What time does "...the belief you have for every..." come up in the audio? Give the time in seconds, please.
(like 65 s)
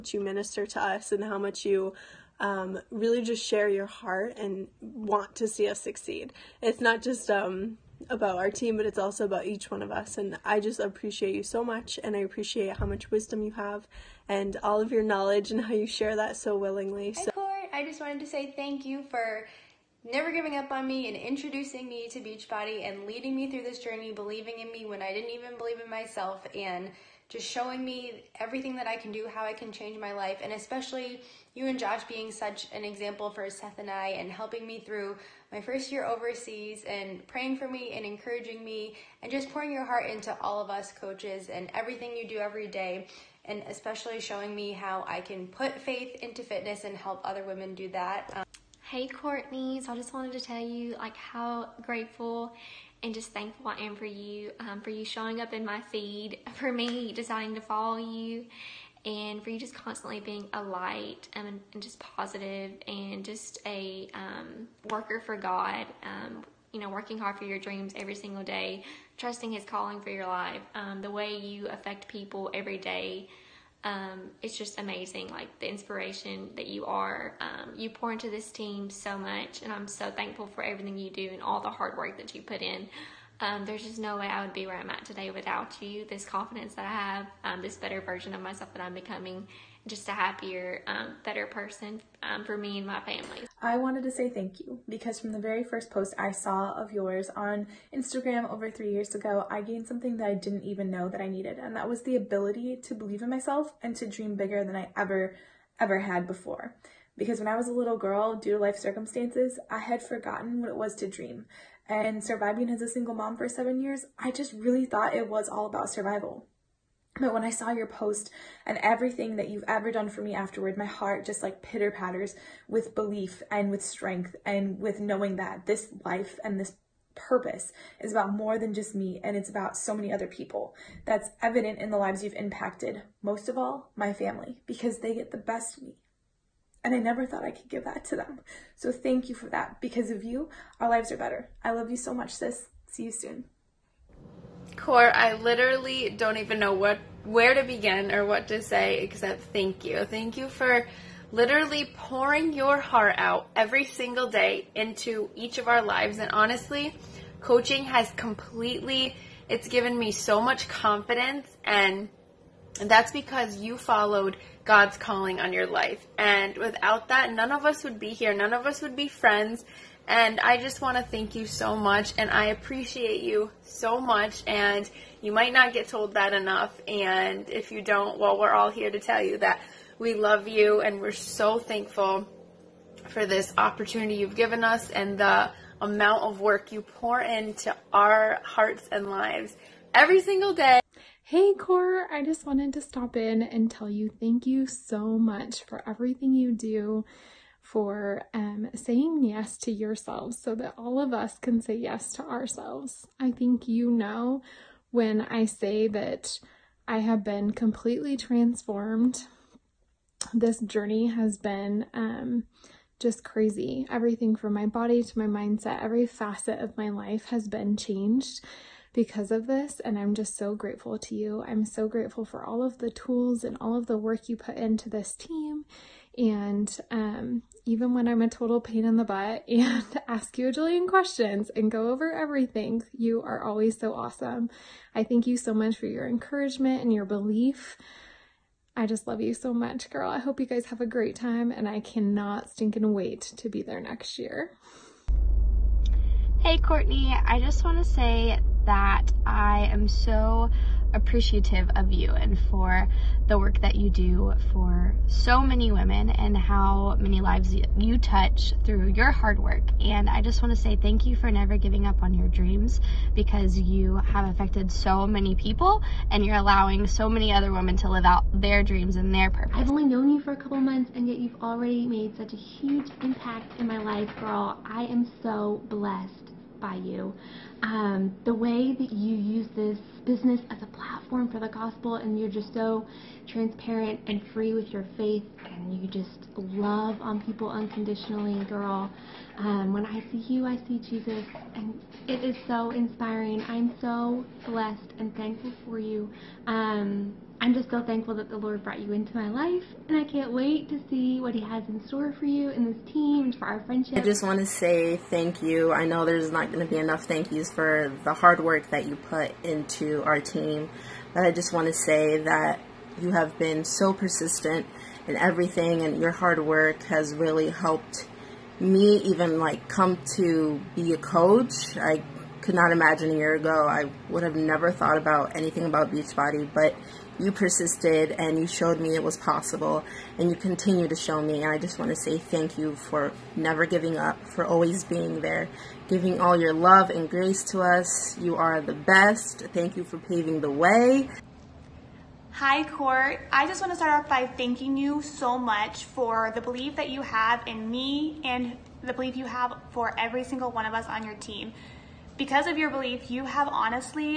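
348 s.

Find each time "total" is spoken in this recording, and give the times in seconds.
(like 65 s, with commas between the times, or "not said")
228 s.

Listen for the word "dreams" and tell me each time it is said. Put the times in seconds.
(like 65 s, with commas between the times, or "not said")
67 s, 104 s, 111 s, 262 s, 268 s.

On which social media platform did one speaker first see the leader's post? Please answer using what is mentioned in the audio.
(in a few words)
Instagram.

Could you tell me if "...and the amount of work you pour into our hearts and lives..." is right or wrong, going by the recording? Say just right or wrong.
right.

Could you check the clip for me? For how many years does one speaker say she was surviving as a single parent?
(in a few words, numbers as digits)
7.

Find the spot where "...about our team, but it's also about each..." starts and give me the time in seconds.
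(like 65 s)
8 s.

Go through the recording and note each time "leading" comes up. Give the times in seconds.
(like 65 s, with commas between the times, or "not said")
23 s.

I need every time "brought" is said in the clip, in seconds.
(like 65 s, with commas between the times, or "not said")
298 s.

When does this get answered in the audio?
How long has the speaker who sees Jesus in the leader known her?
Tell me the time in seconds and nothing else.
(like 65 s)
270 s.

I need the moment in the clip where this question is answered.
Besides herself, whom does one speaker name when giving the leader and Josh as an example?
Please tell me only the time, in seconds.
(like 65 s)
33 s.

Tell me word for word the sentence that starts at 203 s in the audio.
I think you know when I say that I have been completely transformed.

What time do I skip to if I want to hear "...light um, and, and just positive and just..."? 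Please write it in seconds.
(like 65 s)
60 s.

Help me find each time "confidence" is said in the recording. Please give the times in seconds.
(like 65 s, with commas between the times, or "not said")
86 s, 160 s.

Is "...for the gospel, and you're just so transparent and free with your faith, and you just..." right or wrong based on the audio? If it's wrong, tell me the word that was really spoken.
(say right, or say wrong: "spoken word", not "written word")
right.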